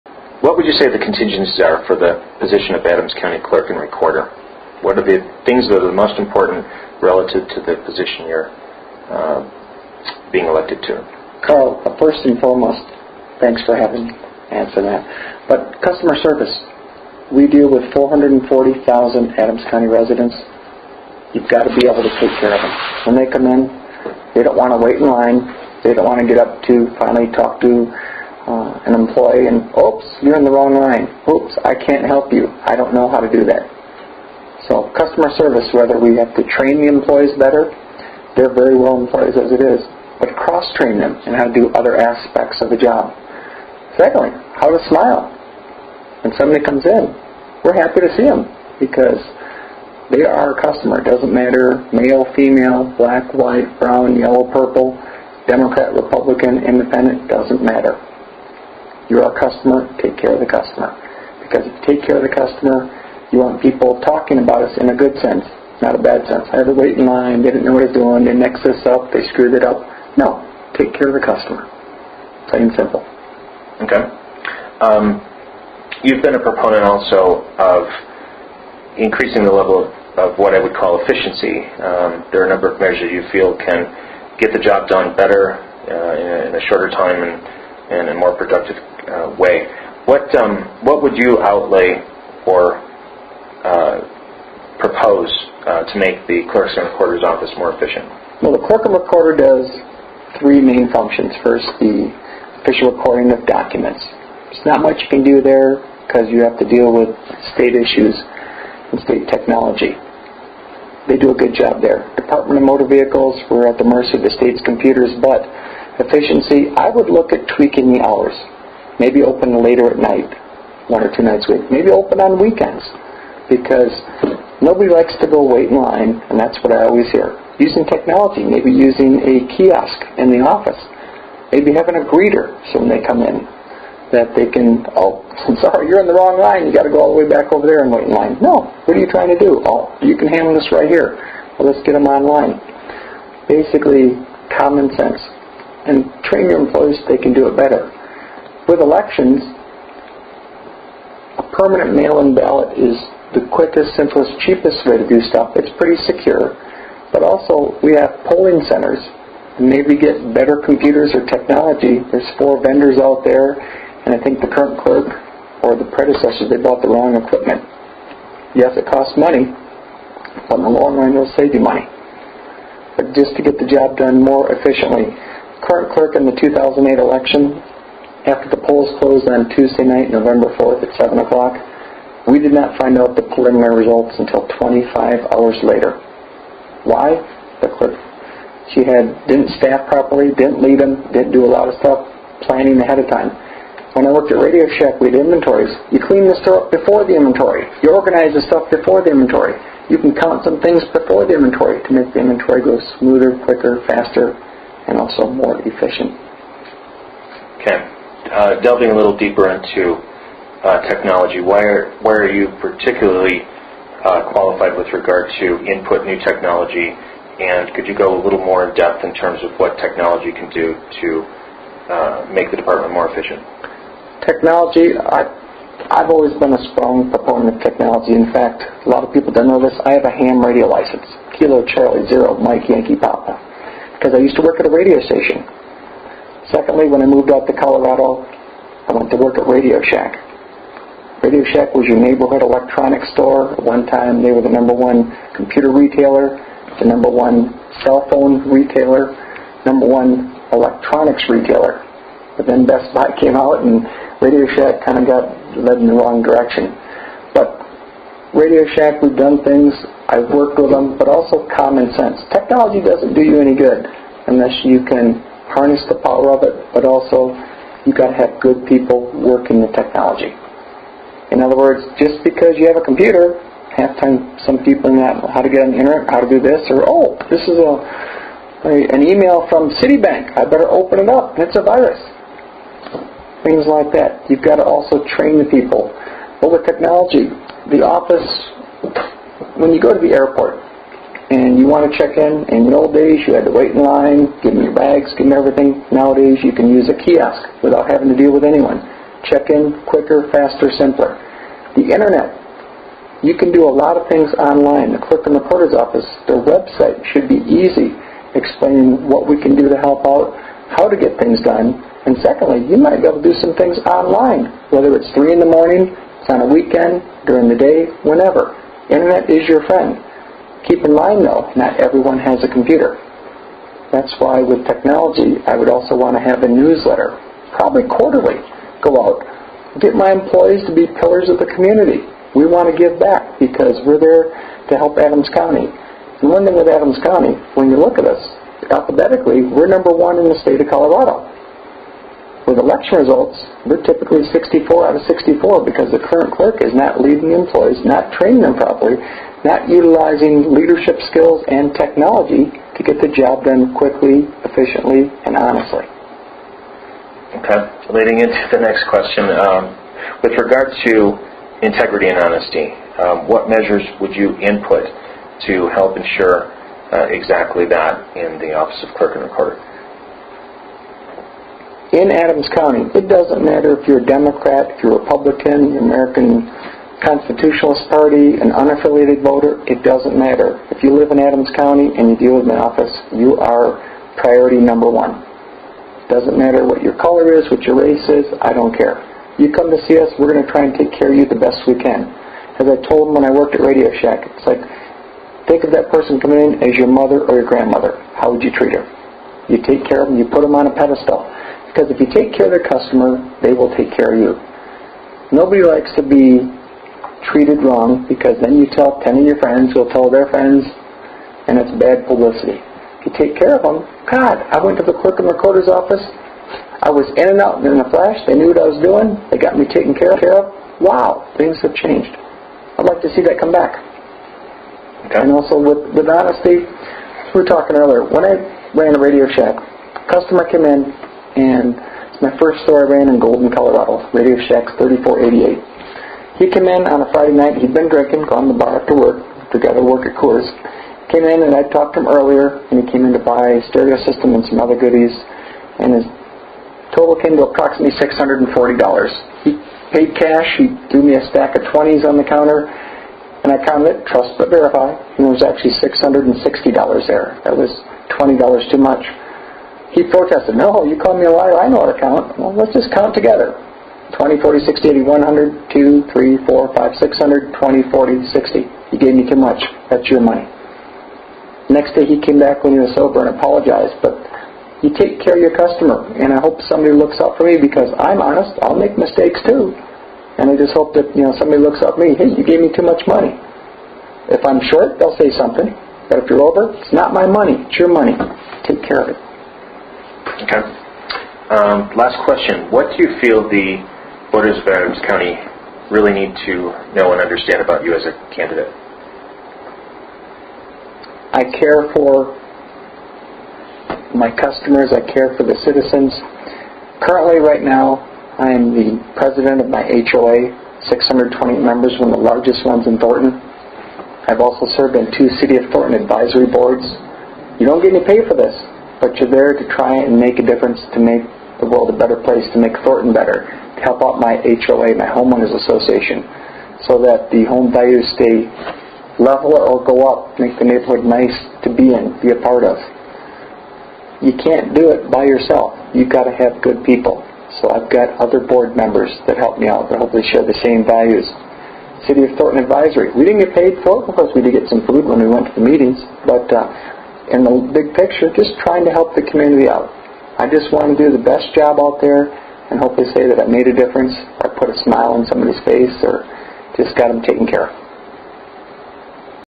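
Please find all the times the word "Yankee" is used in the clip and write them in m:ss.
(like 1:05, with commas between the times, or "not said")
3:52.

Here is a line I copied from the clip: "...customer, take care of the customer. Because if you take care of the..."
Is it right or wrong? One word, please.
right.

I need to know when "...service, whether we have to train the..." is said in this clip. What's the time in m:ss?
0:35.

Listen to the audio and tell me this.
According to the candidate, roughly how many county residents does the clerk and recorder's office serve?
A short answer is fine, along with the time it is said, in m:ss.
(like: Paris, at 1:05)
440,000, at 0:17.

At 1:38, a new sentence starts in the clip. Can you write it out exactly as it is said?
Well, the clerk and recorder does three main functions.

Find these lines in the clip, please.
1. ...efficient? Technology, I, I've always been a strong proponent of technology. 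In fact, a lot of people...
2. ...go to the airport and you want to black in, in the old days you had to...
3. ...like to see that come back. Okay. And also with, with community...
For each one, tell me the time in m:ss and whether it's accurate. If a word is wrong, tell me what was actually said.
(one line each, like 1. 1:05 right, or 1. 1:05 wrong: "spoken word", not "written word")
1. 3:43 right
2. 4:49 wrong: "check", not "black"
3. 7:02 wrong: "honesty", not "community".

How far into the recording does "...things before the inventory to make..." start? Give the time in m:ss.
3:20.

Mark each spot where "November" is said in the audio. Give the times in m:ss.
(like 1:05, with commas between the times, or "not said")
3:00.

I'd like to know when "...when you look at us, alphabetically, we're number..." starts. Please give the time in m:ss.
5:37.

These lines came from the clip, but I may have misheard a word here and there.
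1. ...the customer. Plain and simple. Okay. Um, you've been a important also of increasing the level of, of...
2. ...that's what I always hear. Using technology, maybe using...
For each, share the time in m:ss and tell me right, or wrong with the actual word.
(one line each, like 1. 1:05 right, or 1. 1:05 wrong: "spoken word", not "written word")
1. 1:11 wrong: "proponent", not "important"
2. 2:06 right.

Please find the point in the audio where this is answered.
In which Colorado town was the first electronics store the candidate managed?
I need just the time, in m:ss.
7:13.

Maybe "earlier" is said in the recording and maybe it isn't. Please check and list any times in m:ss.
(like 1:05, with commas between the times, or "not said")
7:07, 7:22.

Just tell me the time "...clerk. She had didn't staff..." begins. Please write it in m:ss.
3:07.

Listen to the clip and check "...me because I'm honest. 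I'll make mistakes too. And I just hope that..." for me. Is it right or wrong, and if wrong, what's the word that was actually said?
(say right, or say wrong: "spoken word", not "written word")
right.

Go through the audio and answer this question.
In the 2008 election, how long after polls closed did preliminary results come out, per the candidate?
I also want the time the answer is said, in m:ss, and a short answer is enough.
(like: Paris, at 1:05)
25 hours, at 3:04.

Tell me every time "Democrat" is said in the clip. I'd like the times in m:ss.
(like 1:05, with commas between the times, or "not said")
0:55, 6:14.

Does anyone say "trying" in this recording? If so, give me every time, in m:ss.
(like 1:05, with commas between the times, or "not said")
2:19, 9:08.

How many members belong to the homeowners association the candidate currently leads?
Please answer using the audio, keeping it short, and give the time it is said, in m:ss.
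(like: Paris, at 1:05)
620, at 8:30.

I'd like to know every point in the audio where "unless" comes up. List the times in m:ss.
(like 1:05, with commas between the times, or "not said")
4:24.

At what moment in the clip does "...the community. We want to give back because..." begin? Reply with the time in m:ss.
5:31.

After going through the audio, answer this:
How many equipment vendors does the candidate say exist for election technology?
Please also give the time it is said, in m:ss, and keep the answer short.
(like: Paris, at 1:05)
4, at 2:42.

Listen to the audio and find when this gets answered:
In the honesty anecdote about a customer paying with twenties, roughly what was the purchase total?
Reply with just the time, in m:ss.
7:27.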